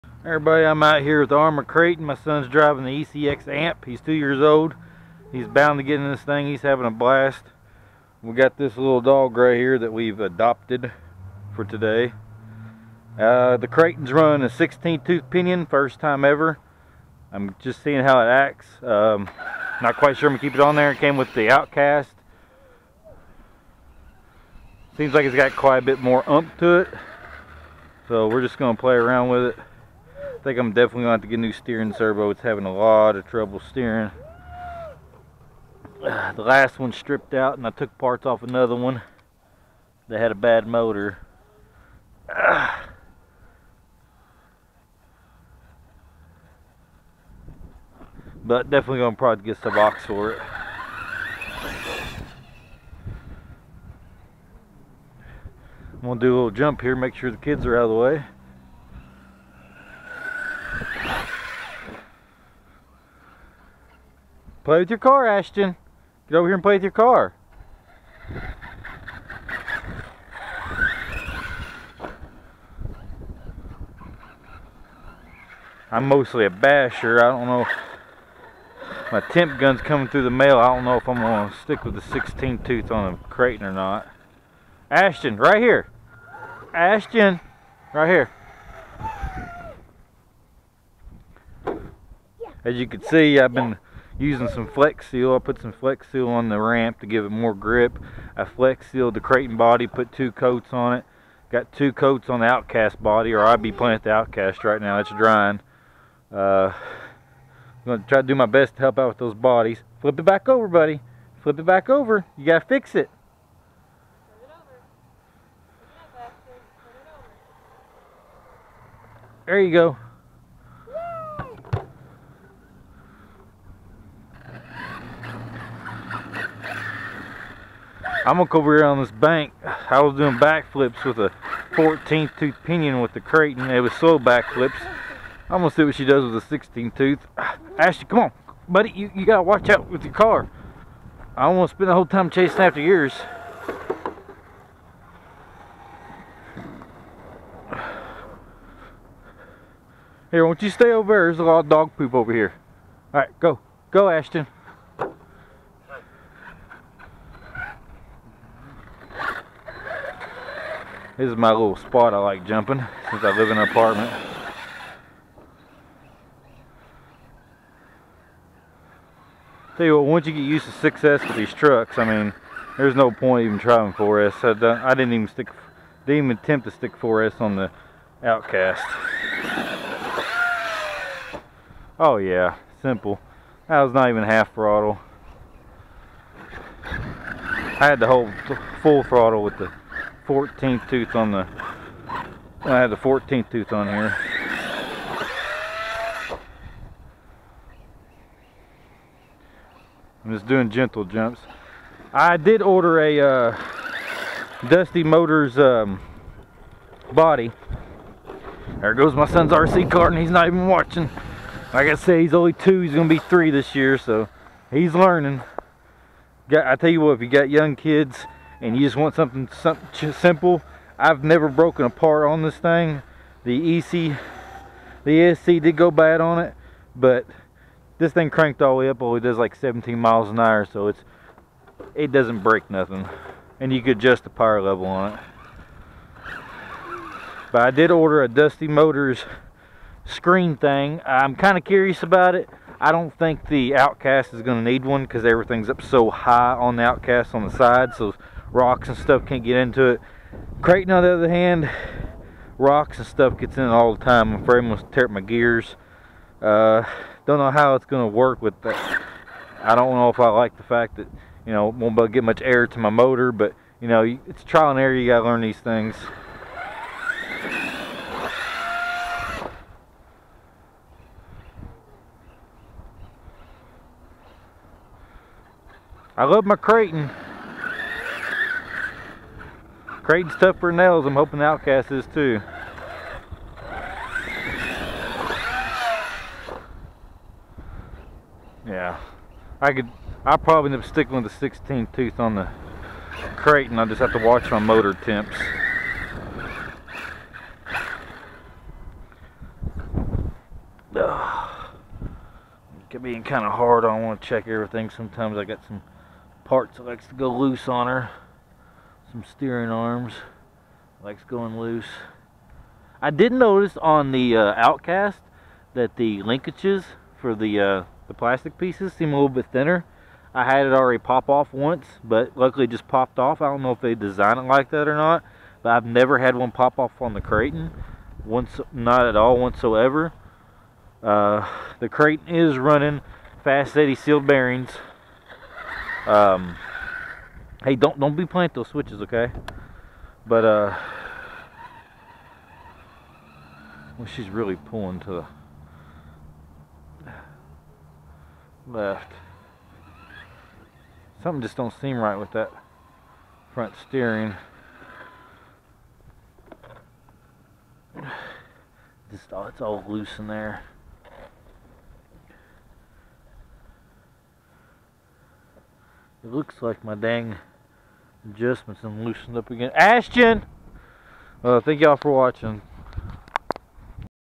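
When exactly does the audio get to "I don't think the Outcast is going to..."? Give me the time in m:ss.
4:02.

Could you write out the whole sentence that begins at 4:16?
Uh, don't know how it's gonna work with that.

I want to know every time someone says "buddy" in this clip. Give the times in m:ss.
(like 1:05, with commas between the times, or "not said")
1:50, 2:18.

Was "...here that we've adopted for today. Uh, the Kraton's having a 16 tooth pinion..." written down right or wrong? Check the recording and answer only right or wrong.
wrong.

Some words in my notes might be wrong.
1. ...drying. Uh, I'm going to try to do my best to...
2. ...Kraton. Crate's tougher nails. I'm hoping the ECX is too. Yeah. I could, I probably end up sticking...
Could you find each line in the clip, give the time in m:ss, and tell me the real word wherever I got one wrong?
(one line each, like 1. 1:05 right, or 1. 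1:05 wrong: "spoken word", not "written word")
1. 1:45 right
2. 4:36 wrong: "Outcast", not "ECX".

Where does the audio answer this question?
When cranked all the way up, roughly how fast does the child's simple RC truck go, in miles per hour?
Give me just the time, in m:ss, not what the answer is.
3:49.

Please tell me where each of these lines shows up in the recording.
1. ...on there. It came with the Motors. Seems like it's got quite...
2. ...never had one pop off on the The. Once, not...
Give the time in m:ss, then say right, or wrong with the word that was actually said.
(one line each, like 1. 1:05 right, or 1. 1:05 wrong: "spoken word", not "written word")
1. 0:20 wrong: "Outcast", not "Motors"
2. 5:25 wrong: "Kraton", not "The".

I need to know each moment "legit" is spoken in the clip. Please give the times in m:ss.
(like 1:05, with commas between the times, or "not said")
not said.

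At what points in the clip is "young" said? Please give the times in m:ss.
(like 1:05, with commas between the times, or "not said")
3:37.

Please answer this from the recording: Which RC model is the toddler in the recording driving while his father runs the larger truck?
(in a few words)
ECX Amp.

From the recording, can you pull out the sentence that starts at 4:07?
So rocks and stuff can't get into it.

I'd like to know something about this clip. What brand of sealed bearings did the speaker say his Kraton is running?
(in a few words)
Fast Eddy.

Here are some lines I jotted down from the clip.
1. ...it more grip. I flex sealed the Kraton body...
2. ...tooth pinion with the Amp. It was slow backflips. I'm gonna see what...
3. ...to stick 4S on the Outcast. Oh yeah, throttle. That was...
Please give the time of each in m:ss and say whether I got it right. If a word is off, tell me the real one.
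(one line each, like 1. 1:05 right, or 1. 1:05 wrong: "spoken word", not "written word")
1. 1:37 right
2. 2:12 wrong: "Kraton", not "Amp"
3. 2:56 wrong: "simple", not "throttle".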